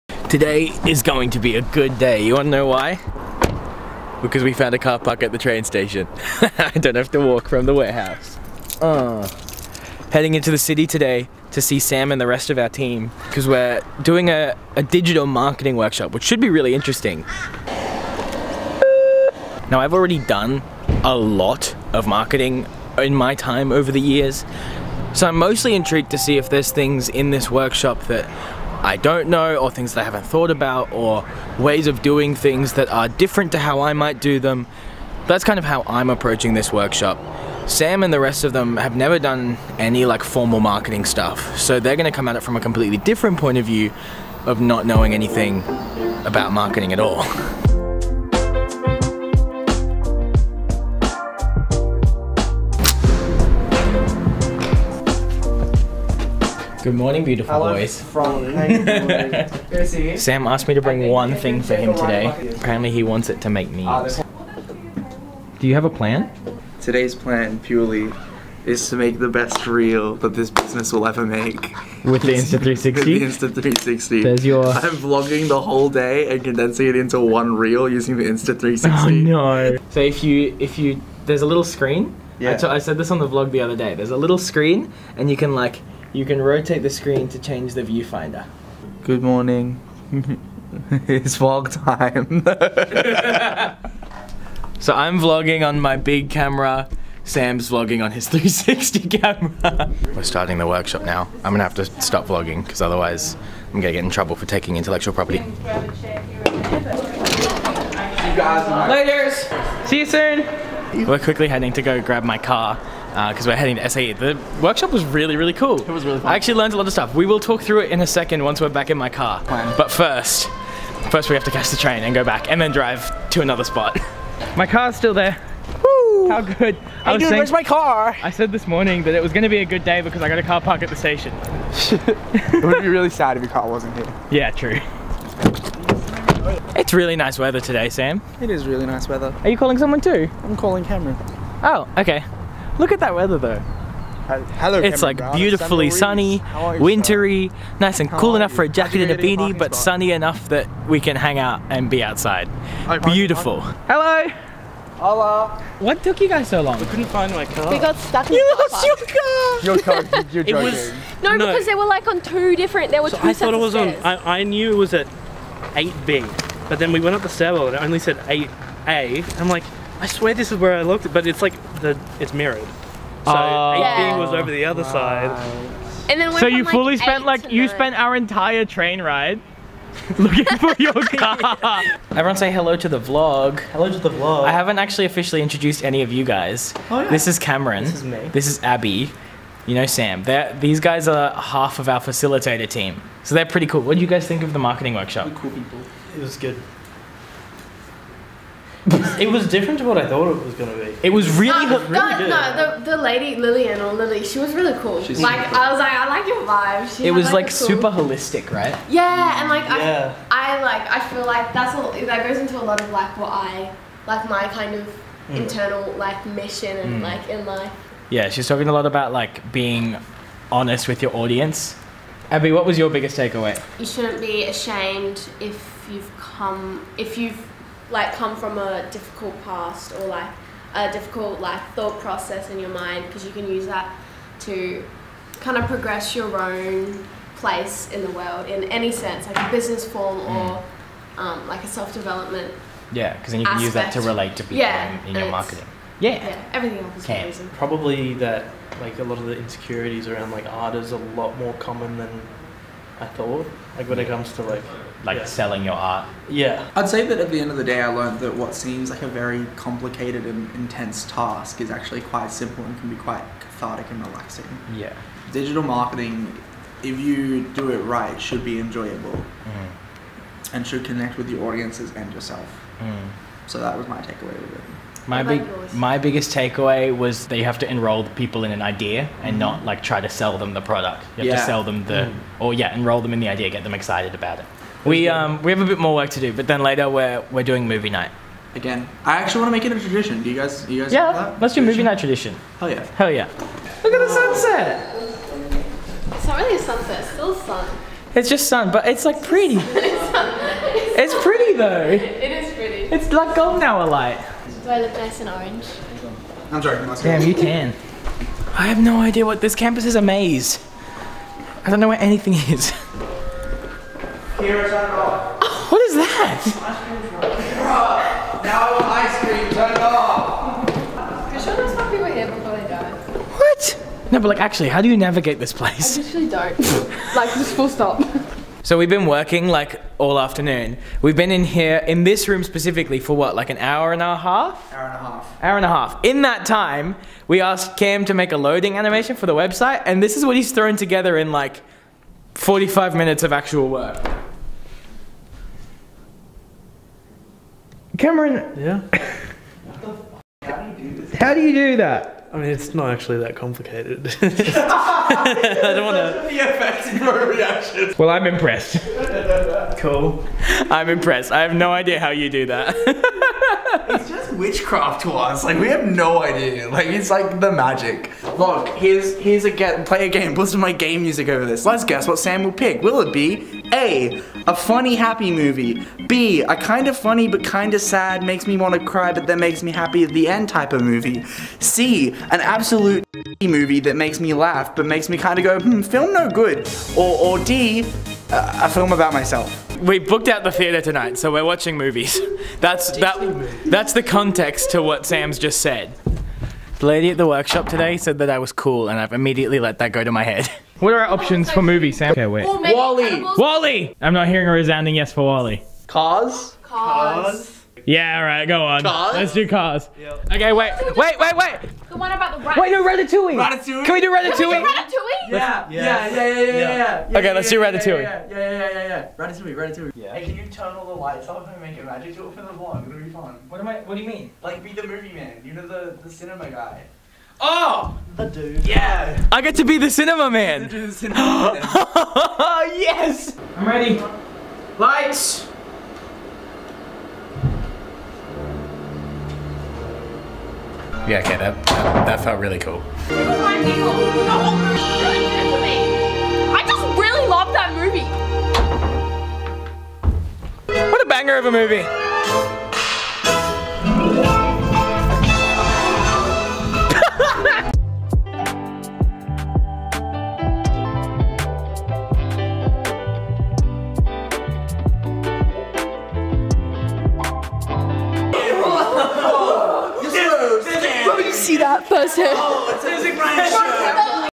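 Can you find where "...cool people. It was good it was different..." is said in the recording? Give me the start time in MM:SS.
03:15.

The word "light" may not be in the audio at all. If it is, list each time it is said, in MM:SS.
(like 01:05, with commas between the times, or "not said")
05:03, 07:00, 07:14.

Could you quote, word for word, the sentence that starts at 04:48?
Again, I actually want to make it a tradition.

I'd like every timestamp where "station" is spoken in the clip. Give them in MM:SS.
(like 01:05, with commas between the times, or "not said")
00:05, 02:10.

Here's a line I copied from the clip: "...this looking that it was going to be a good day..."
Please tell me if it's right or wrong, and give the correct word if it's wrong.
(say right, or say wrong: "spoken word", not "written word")
wrong: "morning", not "looking".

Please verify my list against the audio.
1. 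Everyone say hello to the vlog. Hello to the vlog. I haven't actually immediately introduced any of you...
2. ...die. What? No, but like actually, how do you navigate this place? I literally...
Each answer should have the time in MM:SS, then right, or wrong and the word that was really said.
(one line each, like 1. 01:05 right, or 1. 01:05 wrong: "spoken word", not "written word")
1. 03:02 wrong: "officially", not "immediately"
2. 05:22 right.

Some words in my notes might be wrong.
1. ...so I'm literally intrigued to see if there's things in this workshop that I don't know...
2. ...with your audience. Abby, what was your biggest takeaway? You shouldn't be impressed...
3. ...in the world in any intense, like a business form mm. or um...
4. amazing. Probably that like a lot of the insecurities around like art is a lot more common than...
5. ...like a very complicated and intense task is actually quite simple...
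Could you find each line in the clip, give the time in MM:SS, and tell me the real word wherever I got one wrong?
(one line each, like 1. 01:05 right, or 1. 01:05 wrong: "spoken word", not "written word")
1. 00:25 wrong: "mostly", not "literally"
2. 03:40 wrong: "ashamed", not "impressed"
3. 03:57 wrong: "sense", not "intense"
4. 04:07 right
5. 04:18 right.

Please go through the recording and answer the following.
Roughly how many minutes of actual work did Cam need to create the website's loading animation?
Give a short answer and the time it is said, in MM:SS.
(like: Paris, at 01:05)
45, at 05:42.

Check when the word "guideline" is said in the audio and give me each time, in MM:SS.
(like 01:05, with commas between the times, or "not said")
not said.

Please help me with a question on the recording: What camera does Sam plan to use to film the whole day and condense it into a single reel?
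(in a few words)
Insta360.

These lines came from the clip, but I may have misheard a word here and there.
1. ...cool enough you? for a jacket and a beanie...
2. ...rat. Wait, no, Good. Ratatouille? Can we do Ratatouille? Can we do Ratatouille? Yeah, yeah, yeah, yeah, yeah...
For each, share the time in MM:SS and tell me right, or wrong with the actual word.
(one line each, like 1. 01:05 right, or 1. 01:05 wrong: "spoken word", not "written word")
1. 02:28 right
2. 06:52 wrong: "Ratatouille", not "Good".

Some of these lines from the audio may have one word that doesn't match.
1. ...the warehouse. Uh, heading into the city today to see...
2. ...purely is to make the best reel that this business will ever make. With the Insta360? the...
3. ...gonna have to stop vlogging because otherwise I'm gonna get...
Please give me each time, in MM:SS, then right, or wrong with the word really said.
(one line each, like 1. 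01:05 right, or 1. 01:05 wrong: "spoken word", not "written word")
1. 00:07 right
2. 01:07 right
3. 01:41 right.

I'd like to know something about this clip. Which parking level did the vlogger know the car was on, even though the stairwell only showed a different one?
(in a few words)
8B.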